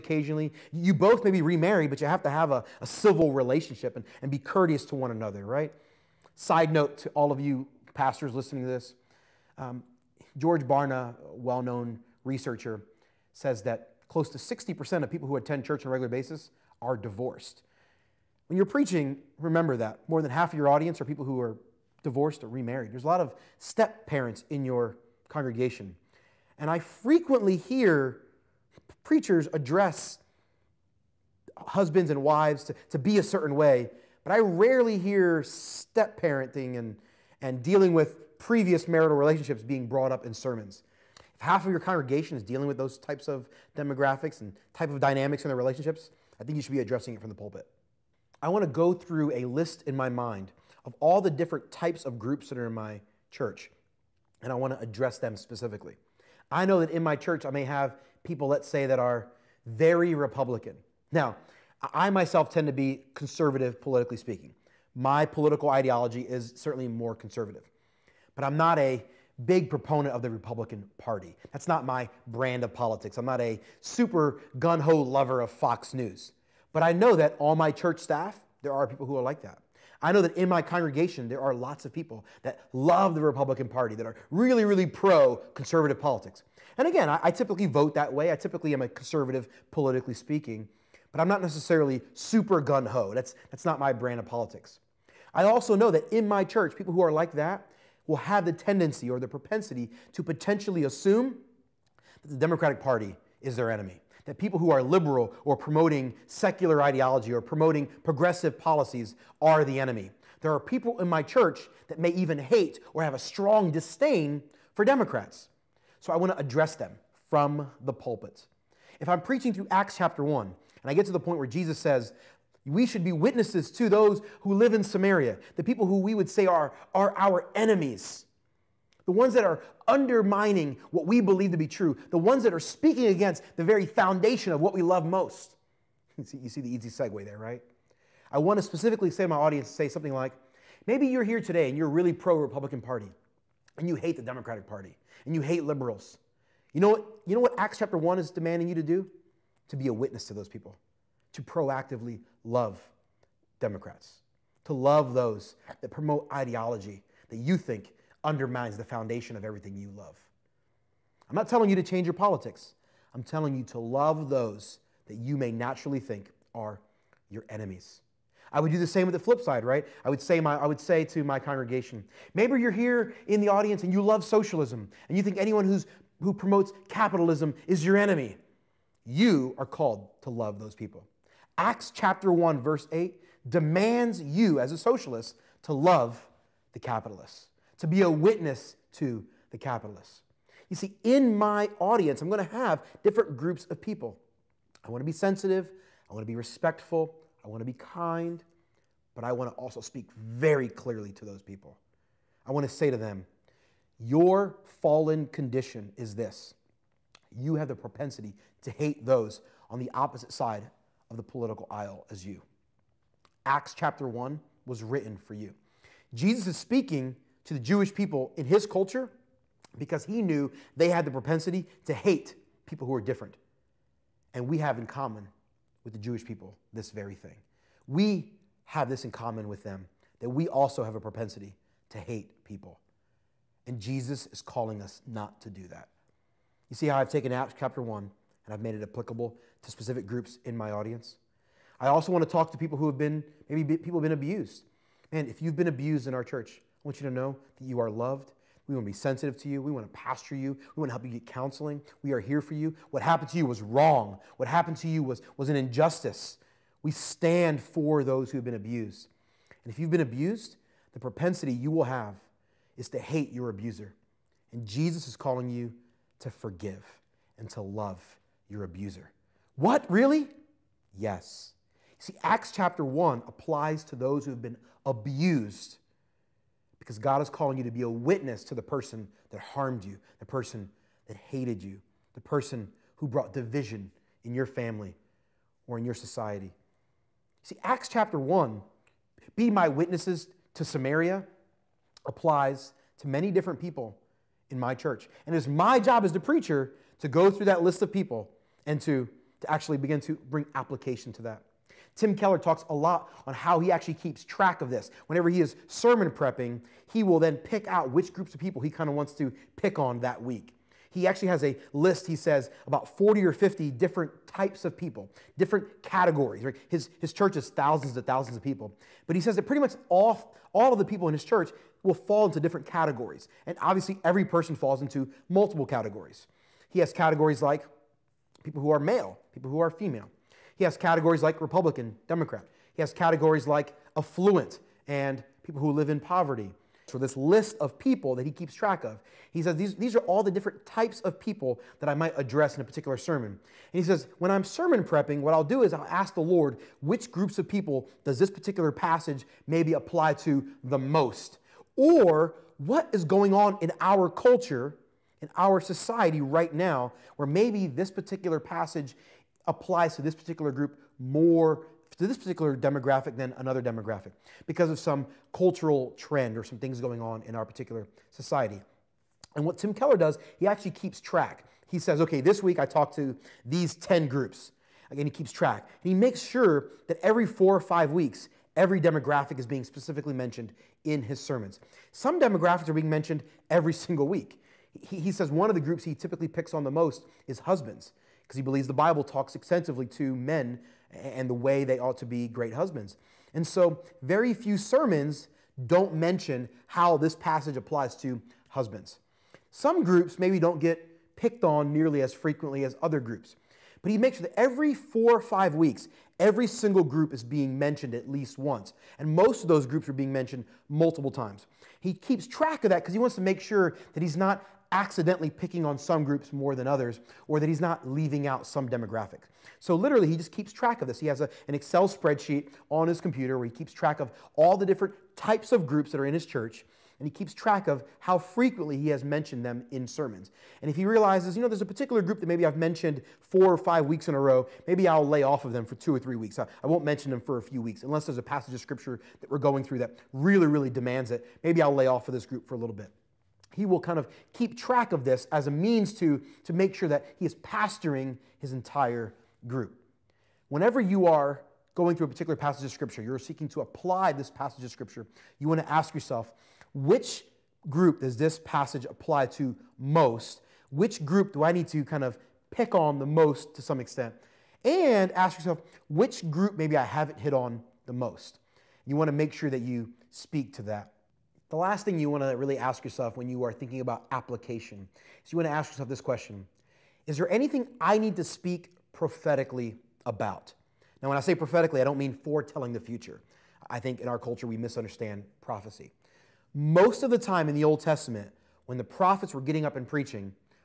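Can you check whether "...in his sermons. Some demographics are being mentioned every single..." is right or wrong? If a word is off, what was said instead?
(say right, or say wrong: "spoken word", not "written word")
right.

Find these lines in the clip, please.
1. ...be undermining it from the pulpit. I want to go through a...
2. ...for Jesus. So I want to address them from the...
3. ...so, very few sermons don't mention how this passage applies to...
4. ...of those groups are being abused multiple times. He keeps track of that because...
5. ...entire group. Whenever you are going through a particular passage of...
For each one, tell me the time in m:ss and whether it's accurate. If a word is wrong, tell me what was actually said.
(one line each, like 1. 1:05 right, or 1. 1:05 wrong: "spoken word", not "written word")
1. 0:46 wrong: "addressing", not "undermining"
2. 1:54 wrong: "Democrats", not "Jesus"
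3. 6:33 right
4. 6:49 wrong: "mentioned", not "abused"
5. 7:28 right.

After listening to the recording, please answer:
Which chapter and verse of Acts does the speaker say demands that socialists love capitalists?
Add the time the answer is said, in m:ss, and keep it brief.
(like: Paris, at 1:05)
Acts 1:8, at 3:01.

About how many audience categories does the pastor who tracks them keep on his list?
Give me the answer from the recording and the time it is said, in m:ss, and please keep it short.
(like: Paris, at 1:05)
40 or 50, at 5:12.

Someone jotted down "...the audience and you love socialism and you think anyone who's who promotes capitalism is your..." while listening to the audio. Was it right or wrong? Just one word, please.
right.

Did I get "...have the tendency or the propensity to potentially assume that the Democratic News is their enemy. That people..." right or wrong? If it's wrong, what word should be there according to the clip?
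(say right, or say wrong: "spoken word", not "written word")
wrong: "Party", not "News".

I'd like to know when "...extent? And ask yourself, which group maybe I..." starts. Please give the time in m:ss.
7:43.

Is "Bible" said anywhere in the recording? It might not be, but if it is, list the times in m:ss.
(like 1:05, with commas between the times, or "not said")
6:28.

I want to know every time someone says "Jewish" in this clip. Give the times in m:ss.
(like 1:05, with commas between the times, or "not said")
3:37, 3:45.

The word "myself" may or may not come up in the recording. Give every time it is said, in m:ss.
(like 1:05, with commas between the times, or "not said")
1:02.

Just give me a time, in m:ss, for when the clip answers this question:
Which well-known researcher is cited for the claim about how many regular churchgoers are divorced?
0:10.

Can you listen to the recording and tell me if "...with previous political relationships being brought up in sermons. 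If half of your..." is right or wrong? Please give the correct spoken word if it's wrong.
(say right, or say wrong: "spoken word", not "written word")
wrong: "marital", not "political".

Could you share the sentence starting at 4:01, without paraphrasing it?
I also want to talk to people who have been, maybe people have been abused.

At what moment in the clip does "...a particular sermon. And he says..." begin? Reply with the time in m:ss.
5:42.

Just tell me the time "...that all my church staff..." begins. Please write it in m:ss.
1:17.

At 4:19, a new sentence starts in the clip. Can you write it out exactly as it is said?
And if you've been abused, the propensity you will have is to hate your abuser.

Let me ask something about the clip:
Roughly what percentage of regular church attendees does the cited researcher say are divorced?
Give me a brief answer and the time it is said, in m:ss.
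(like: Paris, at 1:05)
60%, at 0:14.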